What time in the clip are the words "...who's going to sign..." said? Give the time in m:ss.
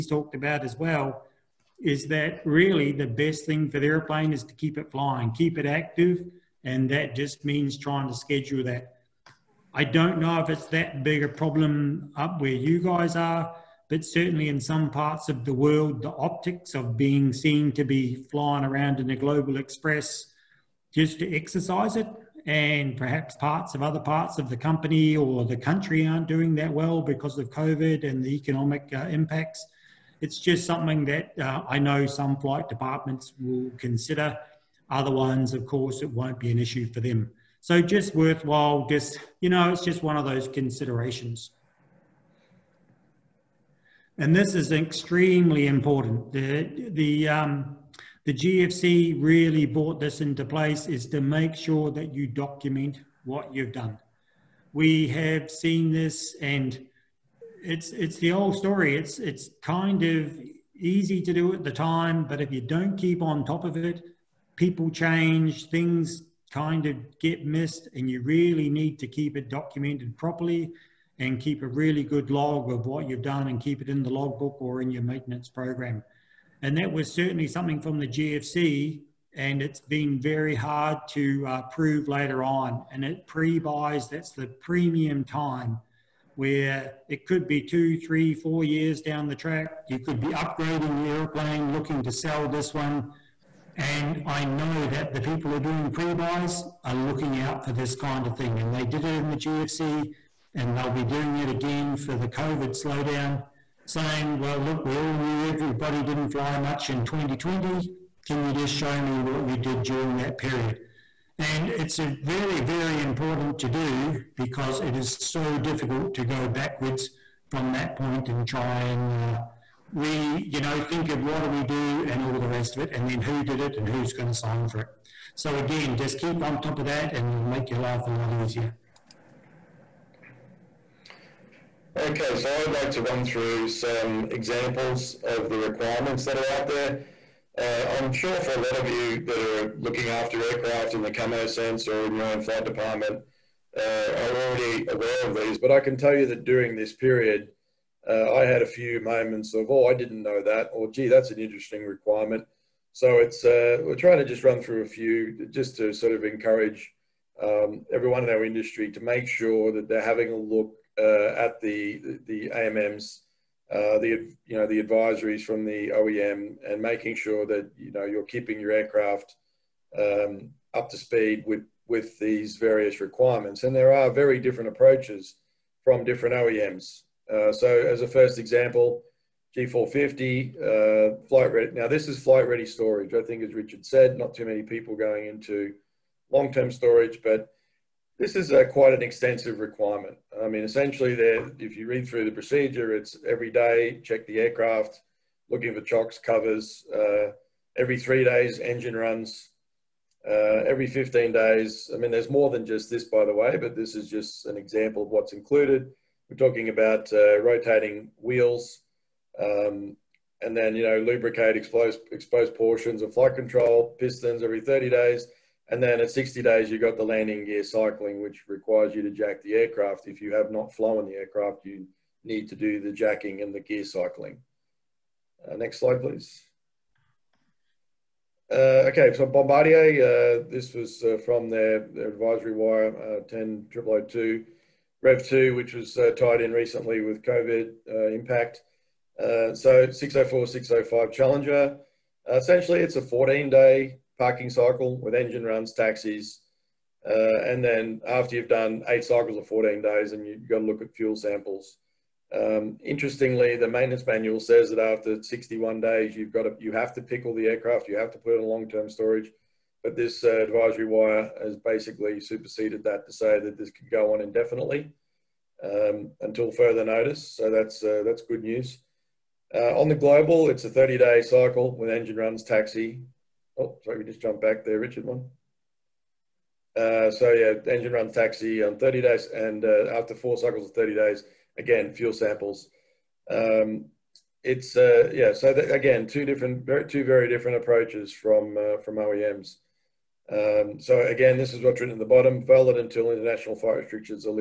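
2:03.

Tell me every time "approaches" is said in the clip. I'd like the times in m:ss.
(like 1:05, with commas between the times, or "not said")
2:54, 4:47.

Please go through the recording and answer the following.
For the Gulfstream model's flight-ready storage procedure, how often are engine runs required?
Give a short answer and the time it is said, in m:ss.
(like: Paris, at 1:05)
every 3 days, at 3:17.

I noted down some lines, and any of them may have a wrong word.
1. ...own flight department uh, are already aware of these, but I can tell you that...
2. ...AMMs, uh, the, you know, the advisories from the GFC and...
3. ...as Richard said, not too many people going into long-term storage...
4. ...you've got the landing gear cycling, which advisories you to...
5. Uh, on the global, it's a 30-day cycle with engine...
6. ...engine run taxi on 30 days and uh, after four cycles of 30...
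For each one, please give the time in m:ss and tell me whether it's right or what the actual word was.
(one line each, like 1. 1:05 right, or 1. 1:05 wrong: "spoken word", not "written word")
1. 2:22 right
2. 2:42 wrong: "OEM", not "GFC"
3. 3:03 right
4. 3:36 wrong: "requires", not "advisories"
5. 4:29 right
6. 4:37 right.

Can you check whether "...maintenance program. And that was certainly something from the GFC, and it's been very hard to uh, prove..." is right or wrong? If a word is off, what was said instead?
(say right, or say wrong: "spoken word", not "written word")
right.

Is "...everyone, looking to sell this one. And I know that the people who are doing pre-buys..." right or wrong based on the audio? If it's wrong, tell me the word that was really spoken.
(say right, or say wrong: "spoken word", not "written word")
wrong: "airplane", not "everyone".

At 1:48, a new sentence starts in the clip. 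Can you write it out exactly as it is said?
Can you just show me what you did during that period?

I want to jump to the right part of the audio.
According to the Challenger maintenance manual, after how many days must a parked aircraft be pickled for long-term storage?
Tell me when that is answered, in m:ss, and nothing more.
4:15.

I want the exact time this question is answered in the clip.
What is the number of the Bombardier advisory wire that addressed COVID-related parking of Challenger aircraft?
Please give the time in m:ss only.
3:53.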